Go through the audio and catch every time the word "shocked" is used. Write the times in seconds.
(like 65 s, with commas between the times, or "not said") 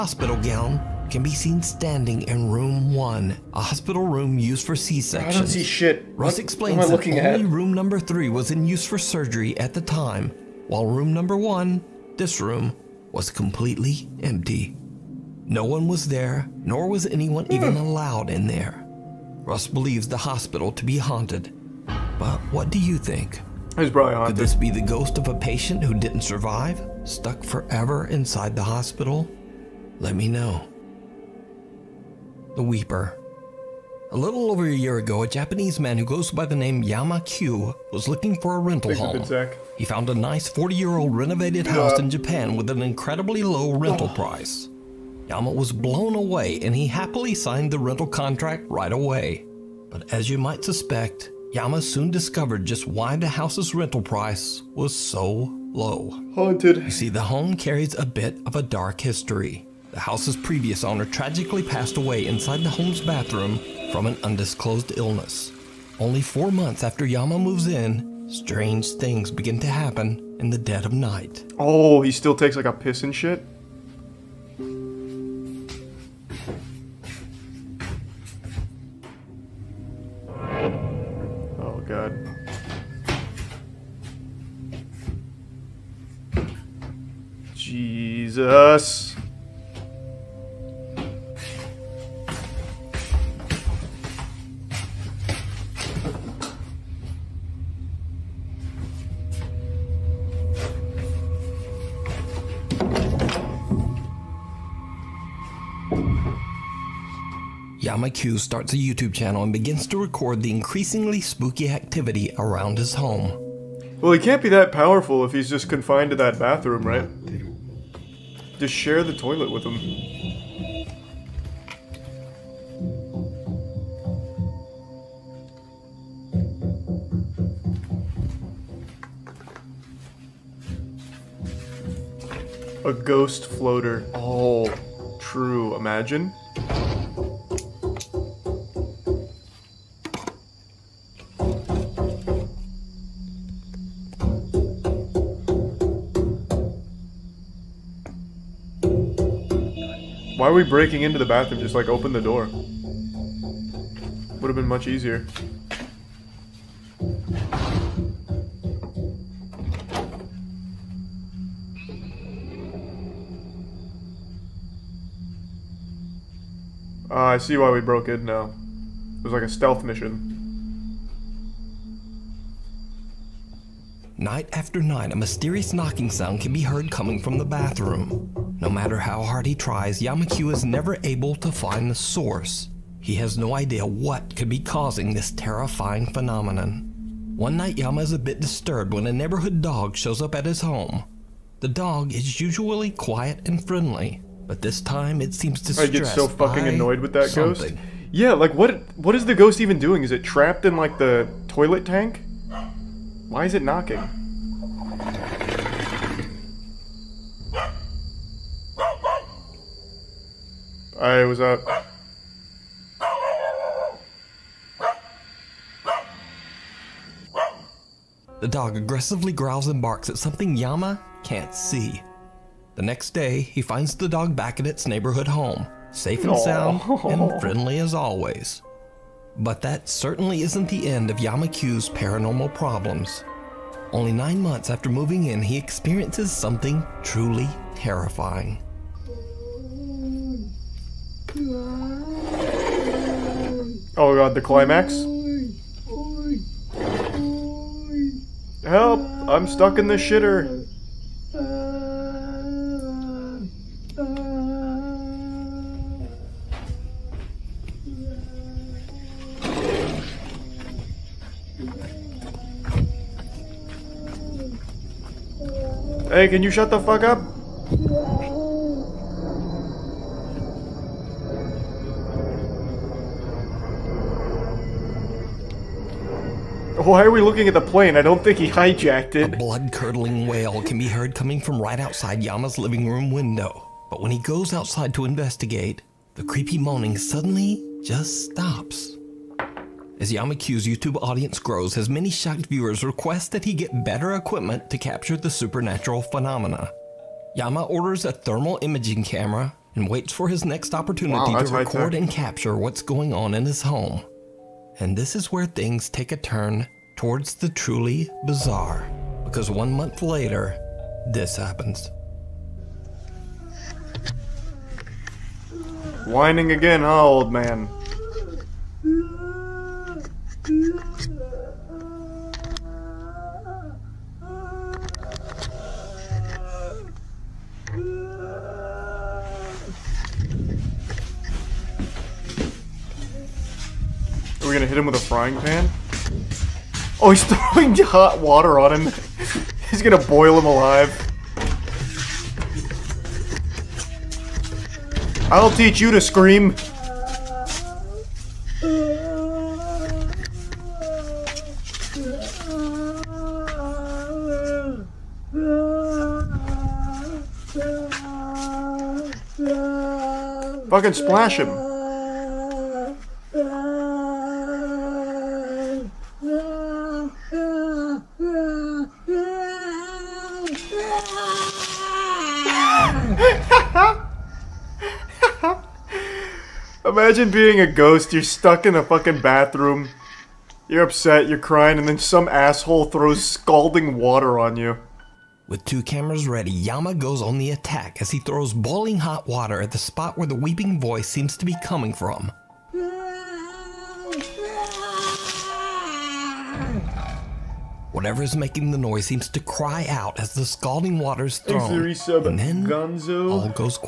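292 s.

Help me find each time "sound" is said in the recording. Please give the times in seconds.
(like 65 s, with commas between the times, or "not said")
176 s, 226 s.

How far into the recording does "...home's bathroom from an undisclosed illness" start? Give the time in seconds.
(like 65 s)
62 s.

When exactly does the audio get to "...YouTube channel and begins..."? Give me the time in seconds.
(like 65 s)
108 s.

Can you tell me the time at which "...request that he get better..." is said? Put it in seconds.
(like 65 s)
292 s.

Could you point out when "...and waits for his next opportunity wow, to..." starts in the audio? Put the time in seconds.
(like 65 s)
299 s.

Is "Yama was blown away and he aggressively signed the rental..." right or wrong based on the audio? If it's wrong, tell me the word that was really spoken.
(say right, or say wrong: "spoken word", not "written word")
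wrong: "happily", not "aggressively".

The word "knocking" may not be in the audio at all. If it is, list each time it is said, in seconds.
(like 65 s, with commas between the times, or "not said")
175 s, 203 s.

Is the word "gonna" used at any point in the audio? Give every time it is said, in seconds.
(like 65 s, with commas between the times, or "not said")
334 s, 339 s.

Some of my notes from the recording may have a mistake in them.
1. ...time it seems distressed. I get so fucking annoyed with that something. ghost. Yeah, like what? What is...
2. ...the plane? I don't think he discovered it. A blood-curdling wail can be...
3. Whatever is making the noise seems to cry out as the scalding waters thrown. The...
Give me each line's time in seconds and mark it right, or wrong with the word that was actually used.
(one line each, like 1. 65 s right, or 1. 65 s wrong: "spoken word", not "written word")
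1. 194 s right
2. 277 s wrong: "hijacked", not "discovered"
3. 397 s right.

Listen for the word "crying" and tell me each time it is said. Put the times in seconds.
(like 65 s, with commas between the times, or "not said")
381 s.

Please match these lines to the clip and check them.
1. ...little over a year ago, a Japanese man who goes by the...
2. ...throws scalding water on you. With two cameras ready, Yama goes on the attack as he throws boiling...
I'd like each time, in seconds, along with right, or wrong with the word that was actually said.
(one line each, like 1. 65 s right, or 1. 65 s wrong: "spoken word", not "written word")
1. 34 s right
2. 382 s right.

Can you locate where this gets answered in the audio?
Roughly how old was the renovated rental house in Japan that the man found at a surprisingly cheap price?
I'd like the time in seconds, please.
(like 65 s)
40 s.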